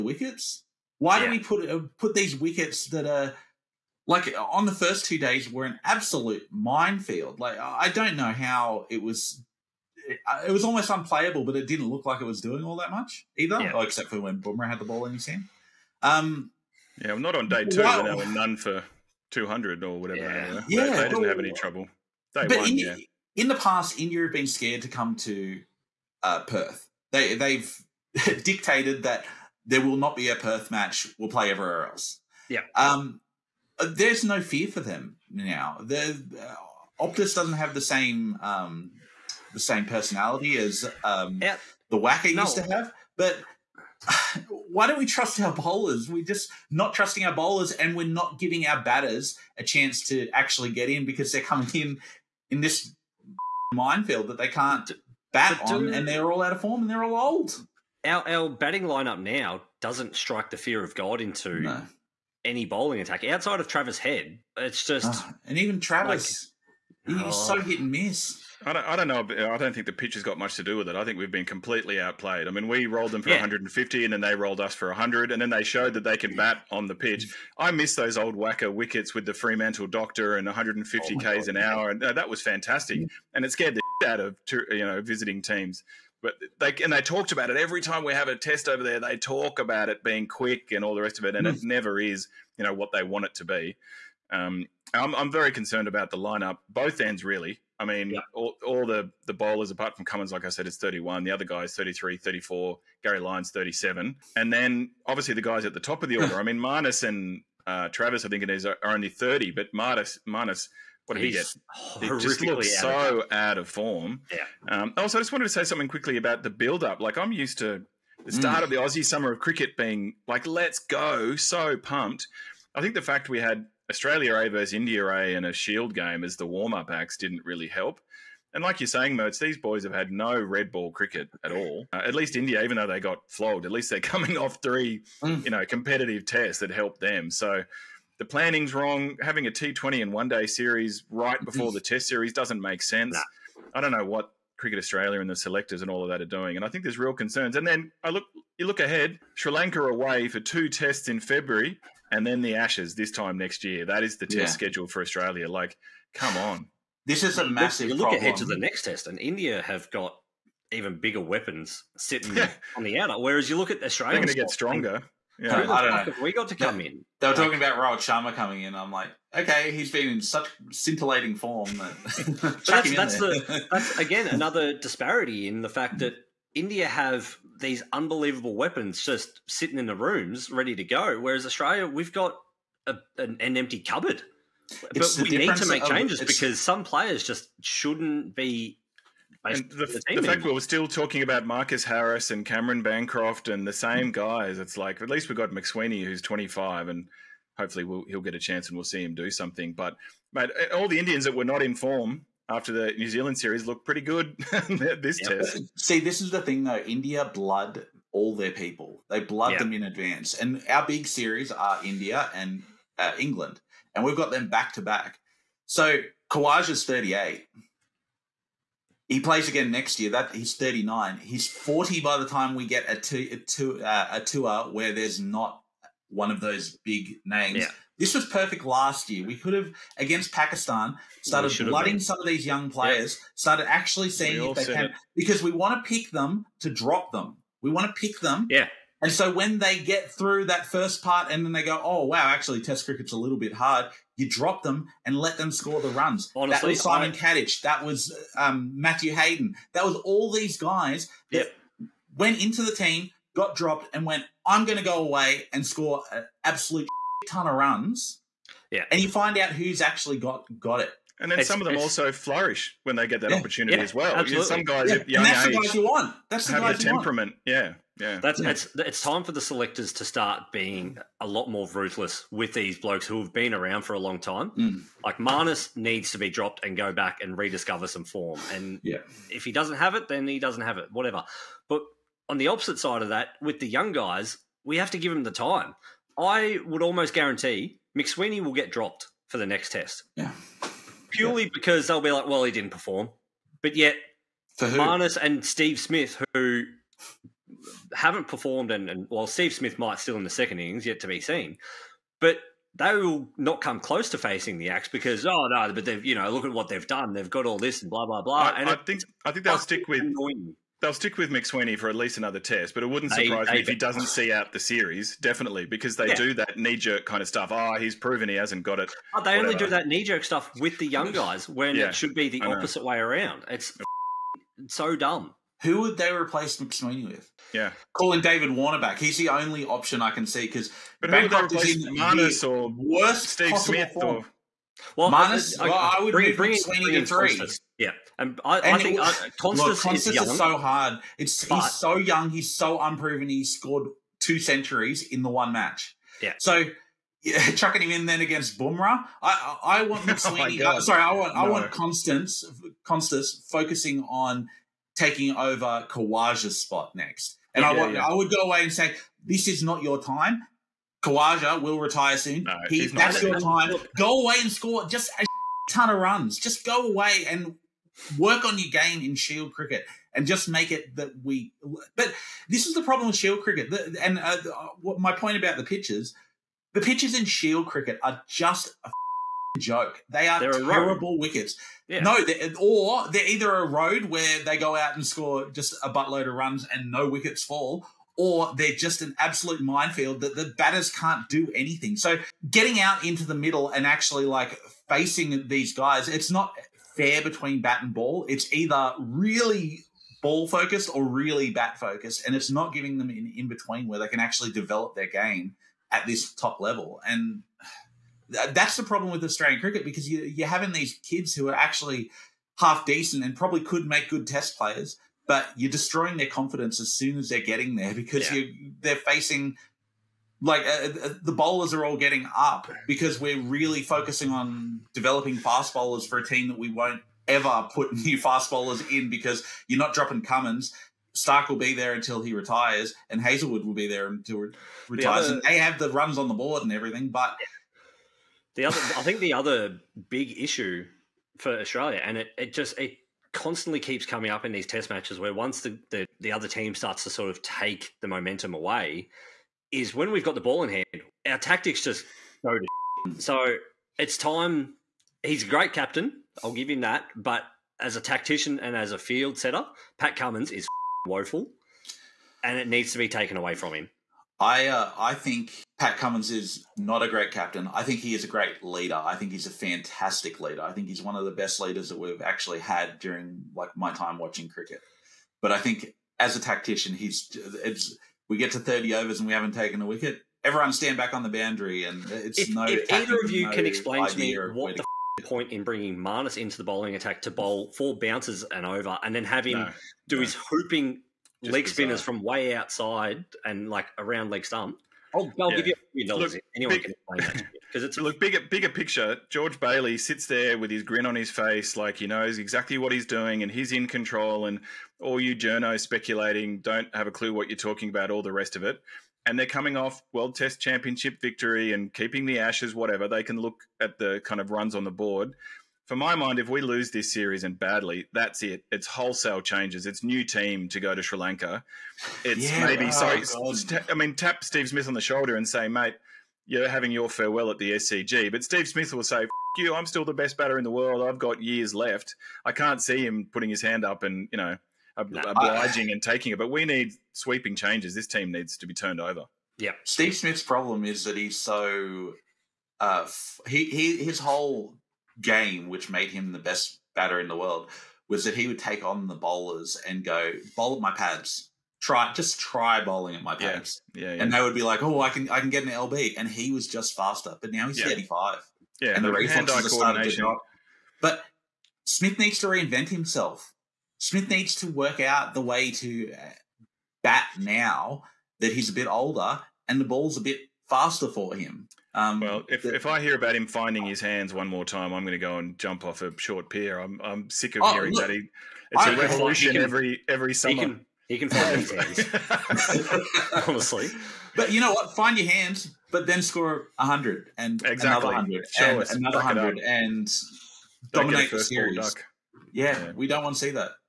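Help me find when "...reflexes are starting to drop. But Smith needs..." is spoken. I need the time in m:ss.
9:19.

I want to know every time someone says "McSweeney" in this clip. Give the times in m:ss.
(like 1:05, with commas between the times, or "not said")
3:15, 4:47, 5:11, 5:26, 5:50.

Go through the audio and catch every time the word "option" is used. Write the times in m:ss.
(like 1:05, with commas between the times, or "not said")
5:29.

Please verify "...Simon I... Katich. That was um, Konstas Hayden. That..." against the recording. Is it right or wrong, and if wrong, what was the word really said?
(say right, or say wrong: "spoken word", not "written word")
wrong: "Matthew", not "Konstas".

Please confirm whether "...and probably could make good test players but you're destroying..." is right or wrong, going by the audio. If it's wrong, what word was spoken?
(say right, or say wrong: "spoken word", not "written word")
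right.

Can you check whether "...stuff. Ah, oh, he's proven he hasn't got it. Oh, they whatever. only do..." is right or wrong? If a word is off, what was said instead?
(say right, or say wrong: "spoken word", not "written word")
right.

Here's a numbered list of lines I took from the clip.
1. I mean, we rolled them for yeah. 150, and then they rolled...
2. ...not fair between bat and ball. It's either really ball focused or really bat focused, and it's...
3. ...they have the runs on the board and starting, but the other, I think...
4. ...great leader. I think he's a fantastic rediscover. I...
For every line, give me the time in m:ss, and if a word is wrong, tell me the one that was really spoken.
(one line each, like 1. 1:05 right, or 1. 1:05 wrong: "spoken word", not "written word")
1. 1:12 right
2. 6:36 right
3. 7:15 wrong: "everything", not "starting"
4. 7:48 wrong: "leader", not "rediscover".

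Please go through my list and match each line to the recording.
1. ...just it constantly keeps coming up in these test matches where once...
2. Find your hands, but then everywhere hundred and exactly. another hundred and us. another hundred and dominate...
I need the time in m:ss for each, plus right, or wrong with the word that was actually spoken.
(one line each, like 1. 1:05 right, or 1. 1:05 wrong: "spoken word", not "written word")
1. 7:22 right
2. 9:44 wrong: "score", not "everywhere".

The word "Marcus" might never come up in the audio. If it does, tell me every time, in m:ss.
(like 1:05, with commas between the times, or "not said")
3:11.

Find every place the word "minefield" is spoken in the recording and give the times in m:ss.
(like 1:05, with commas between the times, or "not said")
0:06, 0:53, 6:29.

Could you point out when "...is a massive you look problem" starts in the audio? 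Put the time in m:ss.
2:37.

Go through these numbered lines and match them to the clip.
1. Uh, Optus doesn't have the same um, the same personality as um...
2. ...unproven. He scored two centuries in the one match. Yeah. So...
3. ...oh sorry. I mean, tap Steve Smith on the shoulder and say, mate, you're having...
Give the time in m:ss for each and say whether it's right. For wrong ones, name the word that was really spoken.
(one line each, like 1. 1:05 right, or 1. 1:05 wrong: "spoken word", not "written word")
1. 0:35 right
2. 5:42 right
3. 8:42 right.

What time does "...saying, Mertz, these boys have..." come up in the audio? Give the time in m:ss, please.
2:08.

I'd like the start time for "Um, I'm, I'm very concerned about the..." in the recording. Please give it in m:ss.
1:34.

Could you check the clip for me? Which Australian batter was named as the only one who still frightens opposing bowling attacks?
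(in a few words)
Travis Head.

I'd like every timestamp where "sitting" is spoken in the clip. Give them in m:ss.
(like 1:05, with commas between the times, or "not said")
2:41, 2:59.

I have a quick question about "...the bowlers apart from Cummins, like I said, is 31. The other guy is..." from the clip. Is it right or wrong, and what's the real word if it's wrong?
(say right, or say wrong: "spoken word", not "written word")
right.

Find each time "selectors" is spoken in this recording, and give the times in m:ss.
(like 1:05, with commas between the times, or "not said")
2:25, 4:29.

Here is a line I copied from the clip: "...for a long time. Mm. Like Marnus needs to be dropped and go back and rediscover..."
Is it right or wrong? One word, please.
right.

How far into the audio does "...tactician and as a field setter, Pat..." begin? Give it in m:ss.
7:37.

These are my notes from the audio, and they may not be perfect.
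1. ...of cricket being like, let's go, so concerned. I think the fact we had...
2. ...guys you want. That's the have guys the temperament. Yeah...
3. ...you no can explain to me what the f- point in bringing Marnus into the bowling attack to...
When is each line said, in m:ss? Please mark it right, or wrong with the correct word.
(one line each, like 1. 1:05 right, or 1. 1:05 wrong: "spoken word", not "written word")
1. 1:59 wrong: "pumped", not "concerned"
2. 4:25 right
3. 8:03 right.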